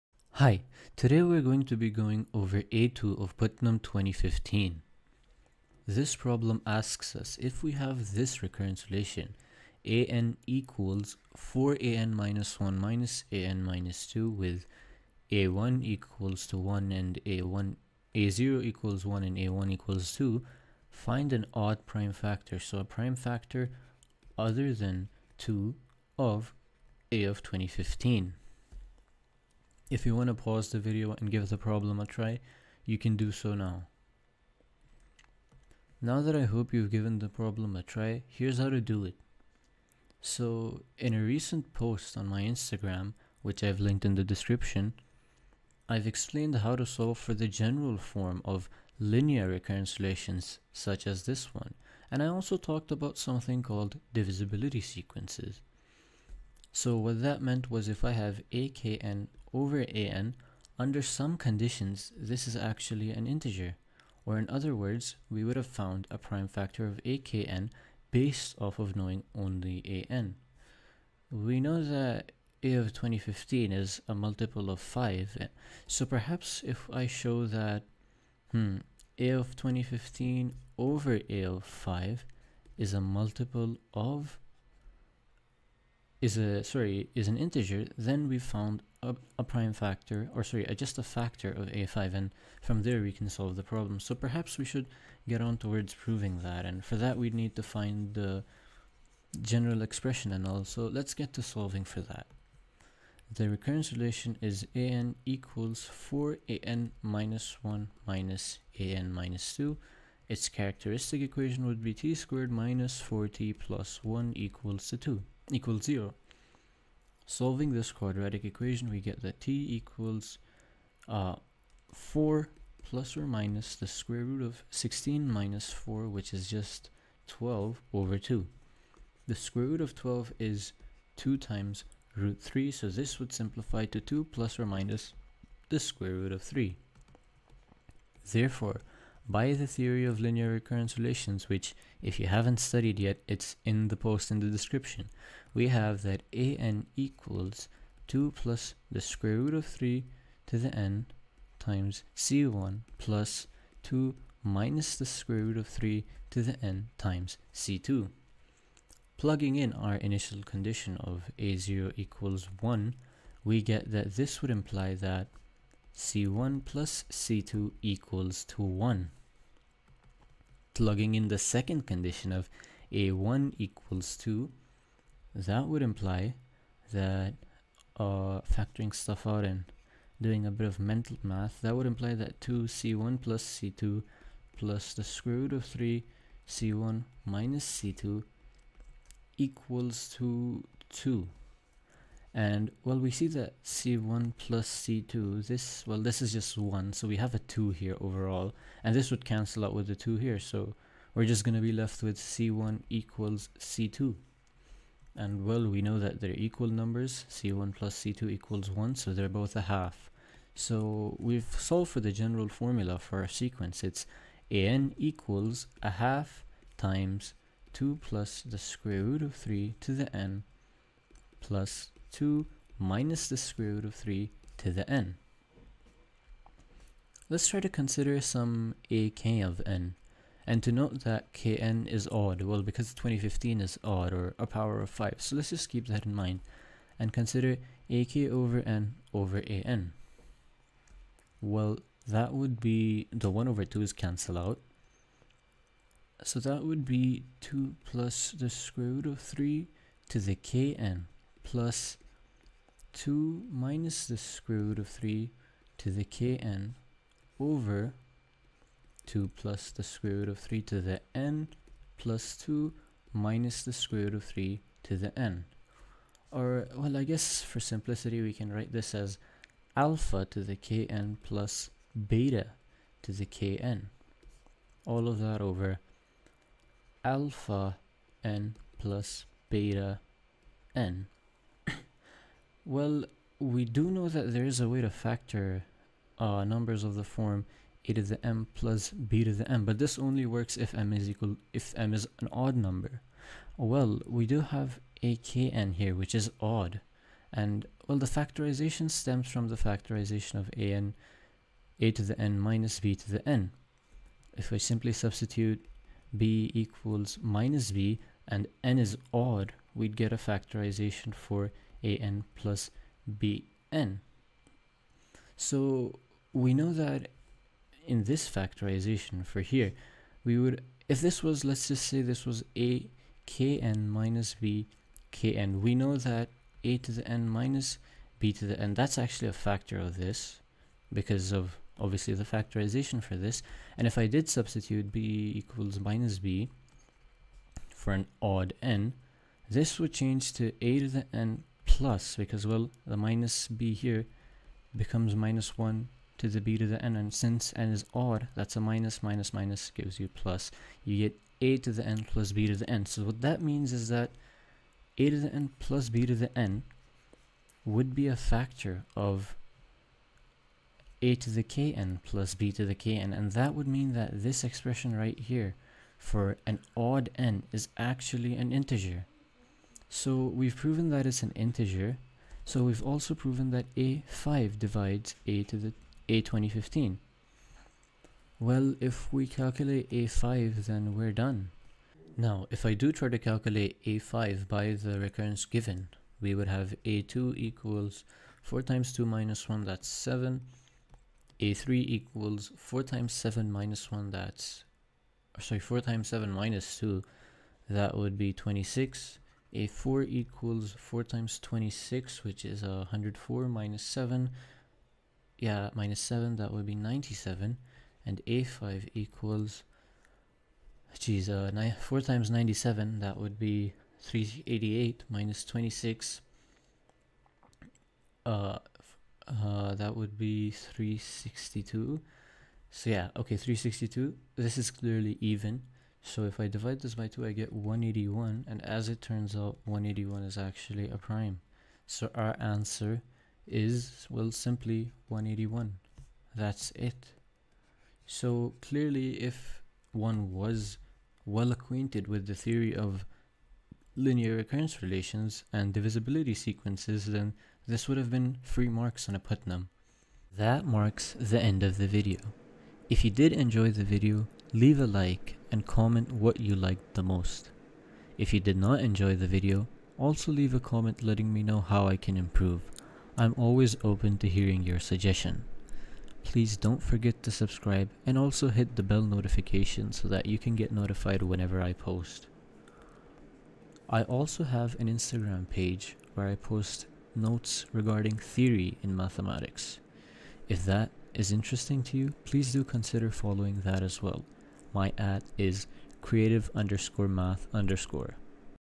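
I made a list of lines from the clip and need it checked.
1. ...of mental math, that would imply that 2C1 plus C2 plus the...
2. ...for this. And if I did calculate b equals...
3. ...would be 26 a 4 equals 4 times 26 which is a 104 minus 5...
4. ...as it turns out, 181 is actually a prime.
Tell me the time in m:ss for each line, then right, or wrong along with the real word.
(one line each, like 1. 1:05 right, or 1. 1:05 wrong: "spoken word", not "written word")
1. 3:00 right
2. 5:33 wrong: "substitute", not "calculate"
3. 6:37 wrong: "7", not "5"
4. 7:08 right.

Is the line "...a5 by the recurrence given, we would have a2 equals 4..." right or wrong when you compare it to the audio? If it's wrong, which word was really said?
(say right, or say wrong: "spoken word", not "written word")
right.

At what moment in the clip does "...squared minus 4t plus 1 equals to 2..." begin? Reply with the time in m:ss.
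1:52.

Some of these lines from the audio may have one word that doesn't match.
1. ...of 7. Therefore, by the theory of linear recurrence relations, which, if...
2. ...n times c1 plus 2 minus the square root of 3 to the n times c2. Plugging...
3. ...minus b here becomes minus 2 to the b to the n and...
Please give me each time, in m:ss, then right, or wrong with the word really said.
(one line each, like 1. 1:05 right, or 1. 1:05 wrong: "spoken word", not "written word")
1. 2:16 wrong: "3", not "7"
2. 2:30 right
3. 5:42 wrong: "1", not "2".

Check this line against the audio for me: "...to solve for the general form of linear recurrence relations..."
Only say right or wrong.
right.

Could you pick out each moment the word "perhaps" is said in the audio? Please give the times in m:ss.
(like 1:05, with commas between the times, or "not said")
1:16, 1:34.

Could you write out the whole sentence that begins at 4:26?
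Or, well, I guess for simplicity, we can write this as alpha to the kn plus beta to the kn.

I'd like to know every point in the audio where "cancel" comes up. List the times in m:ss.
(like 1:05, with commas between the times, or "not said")
3:19, 4:03.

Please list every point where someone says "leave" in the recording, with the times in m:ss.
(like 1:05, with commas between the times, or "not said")
7:34, 7:40.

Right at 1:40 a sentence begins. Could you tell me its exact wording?
So let's get to solving for that.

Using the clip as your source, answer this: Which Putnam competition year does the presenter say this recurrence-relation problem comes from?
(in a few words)
2015.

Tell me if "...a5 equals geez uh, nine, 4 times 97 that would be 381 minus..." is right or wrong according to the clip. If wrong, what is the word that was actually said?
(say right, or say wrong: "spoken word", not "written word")
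wrong: "388", not "381".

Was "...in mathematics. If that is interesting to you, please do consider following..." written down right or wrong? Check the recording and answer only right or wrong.
right.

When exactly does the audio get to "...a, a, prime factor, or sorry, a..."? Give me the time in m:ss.
1:29.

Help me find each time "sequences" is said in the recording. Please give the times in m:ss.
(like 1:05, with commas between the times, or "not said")
0:54, 3:33, 7:26.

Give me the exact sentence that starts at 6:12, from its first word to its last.
So we've also proven that a5 divides a to the a 2015.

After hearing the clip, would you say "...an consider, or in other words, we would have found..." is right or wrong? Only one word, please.
wrong.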